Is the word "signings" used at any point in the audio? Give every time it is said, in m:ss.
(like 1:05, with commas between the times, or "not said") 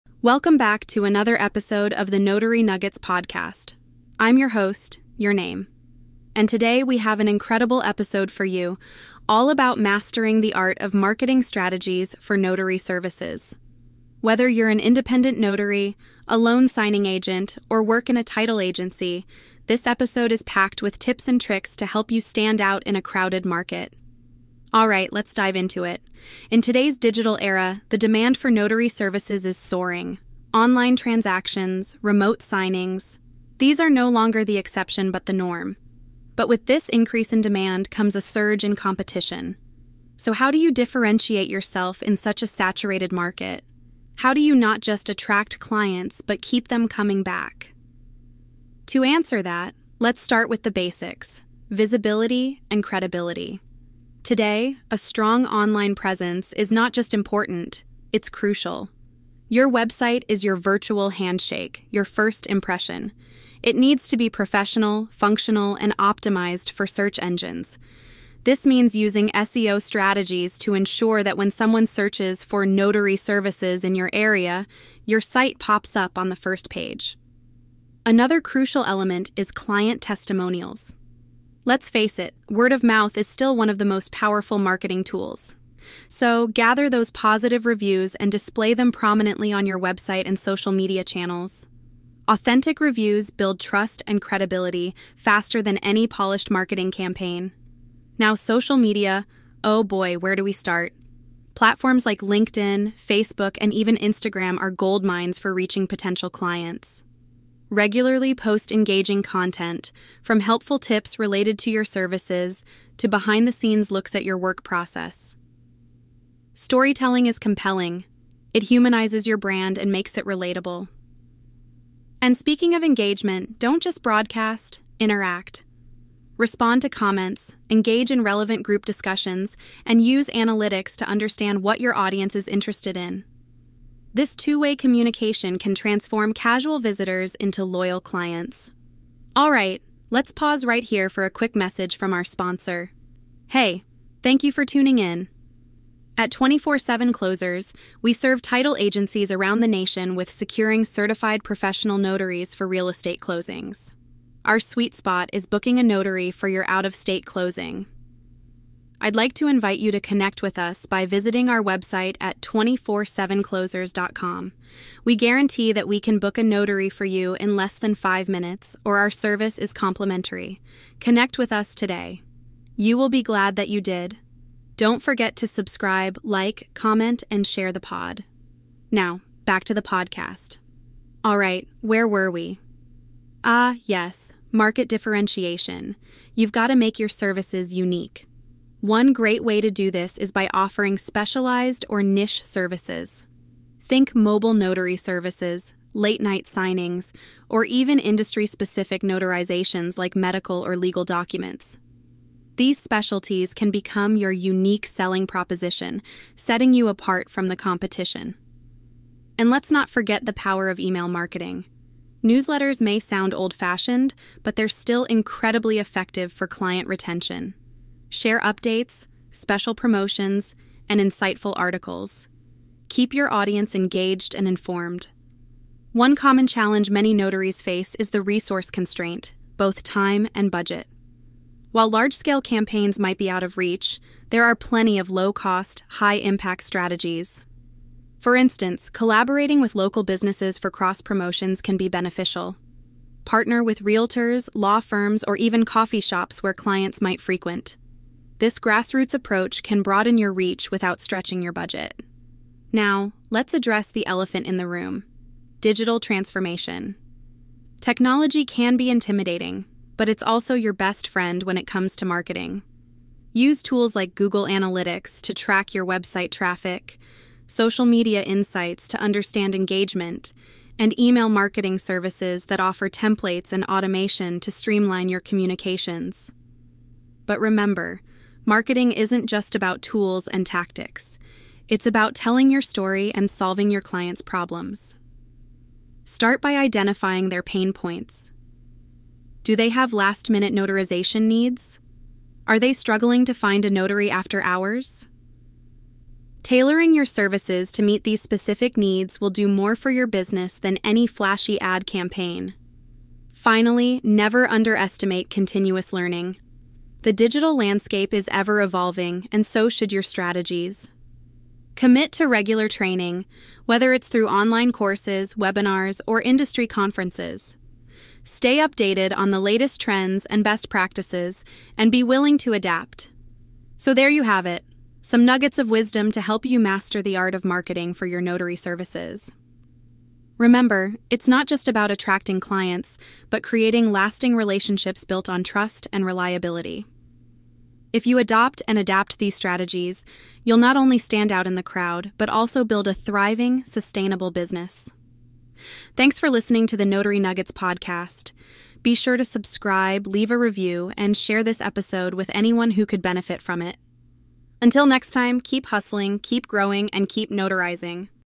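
0:16, 0:32, 3:16.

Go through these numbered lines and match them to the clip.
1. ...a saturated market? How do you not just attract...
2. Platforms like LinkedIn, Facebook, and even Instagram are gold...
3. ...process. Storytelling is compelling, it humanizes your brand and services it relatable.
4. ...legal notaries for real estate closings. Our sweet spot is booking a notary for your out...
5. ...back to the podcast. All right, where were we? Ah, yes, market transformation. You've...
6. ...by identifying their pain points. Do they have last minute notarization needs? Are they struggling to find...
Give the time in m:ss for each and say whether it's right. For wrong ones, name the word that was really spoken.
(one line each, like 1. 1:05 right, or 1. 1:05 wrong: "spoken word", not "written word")
1. 0:42 right
2. 1:41 right
3. 1:54 wrong: "makes", not "services"
4. 2:31 wrong: "professional", not "legal"
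5. 2:59 wrong: "differentiation", not "transformation"
6. 4:46 right.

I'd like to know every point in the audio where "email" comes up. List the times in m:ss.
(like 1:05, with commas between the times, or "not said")
3:30, 4:30.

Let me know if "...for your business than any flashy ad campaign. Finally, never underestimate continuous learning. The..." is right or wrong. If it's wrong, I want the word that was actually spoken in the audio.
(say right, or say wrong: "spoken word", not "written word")
right.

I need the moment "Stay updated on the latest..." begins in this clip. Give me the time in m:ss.
5:18.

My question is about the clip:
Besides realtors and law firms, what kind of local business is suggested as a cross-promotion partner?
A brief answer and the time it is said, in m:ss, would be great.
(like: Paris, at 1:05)
coffee shops, at 4:05.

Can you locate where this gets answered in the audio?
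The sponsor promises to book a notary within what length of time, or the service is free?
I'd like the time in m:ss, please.
2:47.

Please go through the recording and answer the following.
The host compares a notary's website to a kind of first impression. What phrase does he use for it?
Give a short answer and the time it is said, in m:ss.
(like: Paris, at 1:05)
virtual handshake, at 1:00.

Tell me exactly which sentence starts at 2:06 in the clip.
Respond to comments, engage in relevant group discussions, and use analytics to understand what your audience is interested in.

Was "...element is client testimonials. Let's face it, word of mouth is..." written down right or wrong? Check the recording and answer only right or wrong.
right.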